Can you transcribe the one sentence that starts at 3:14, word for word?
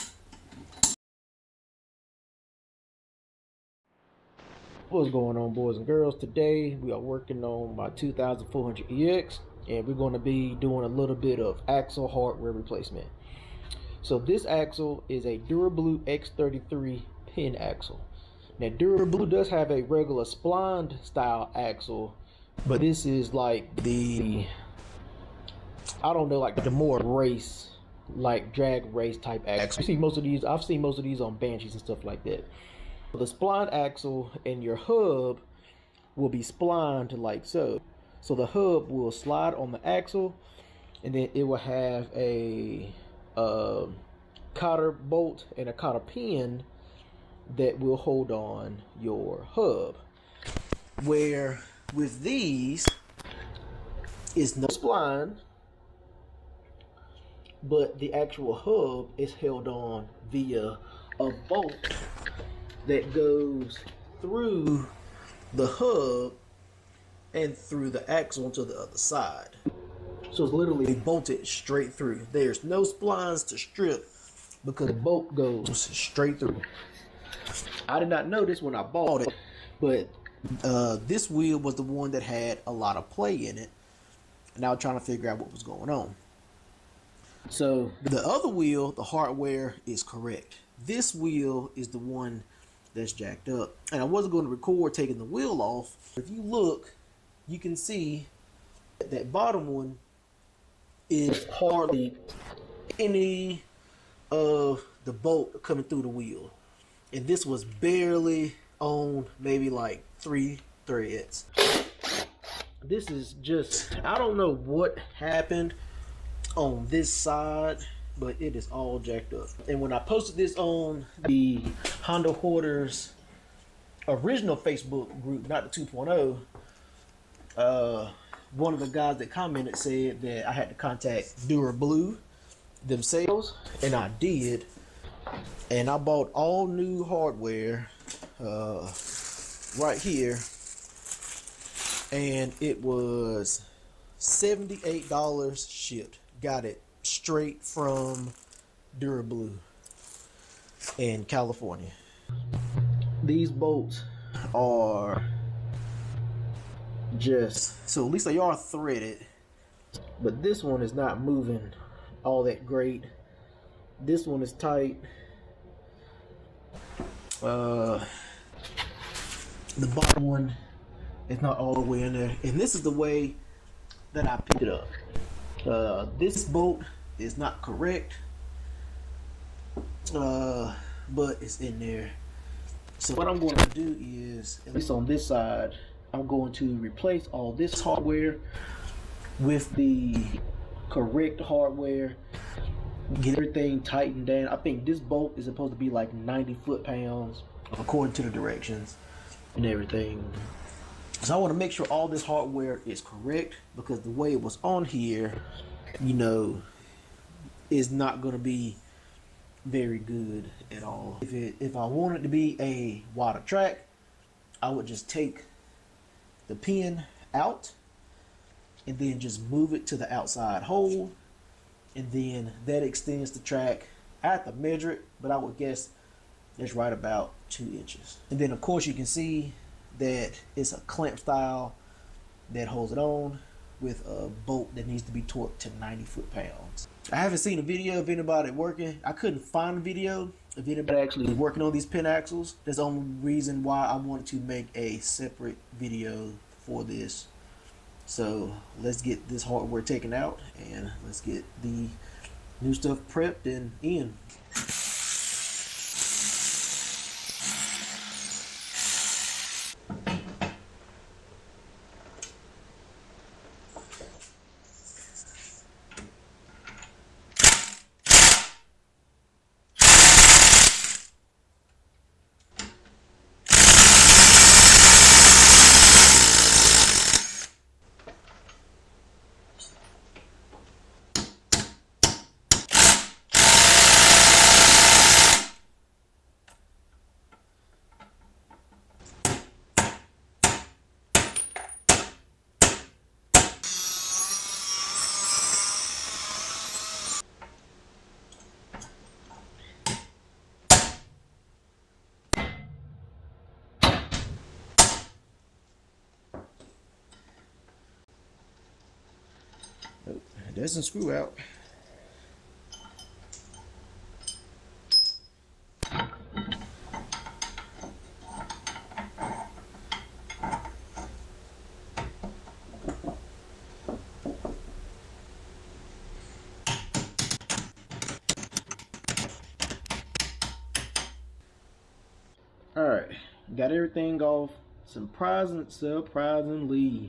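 I think this bolt is supposed to be like 90 foot pounds according to the directions and everything.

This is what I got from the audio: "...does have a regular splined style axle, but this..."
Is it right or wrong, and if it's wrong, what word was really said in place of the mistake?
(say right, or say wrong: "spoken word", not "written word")
right.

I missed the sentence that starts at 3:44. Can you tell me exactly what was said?
I have to measure it, but I would guess it's right about two inches.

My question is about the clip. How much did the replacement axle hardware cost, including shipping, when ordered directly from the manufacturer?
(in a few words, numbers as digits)
$78.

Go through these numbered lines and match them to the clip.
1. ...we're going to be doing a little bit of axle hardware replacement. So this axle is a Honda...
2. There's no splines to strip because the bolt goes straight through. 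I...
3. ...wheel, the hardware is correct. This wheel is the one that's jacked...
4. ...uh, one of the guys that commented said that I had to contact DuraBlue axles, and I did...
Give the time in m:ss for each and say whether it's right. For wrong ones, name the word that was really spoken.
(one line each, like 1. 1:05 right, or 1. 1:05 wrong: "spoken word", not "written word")
1. 0:09 wrong: "DuraBlue", not "Honda"
2. 1:12 right
3. 1:28 right
4. 2:07 wrong: "themselves", not "axles".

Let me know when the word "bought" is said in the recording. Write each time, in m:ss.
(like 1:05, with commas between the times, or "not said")
1:18, 2:15.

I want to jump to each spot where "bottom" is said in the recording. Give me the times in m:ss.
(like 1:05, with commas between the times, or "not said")
1:39, 2:49.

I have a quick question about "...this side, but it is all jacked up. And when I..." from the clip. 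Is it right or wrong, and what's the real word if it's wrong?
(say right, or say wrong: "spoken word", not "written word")
right.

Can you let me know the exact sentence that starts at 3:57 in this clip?
I haven't seen a video of anybody working.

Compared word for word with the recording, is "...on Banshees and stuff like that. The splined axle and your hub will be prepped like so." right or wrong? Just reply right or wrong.
wrong.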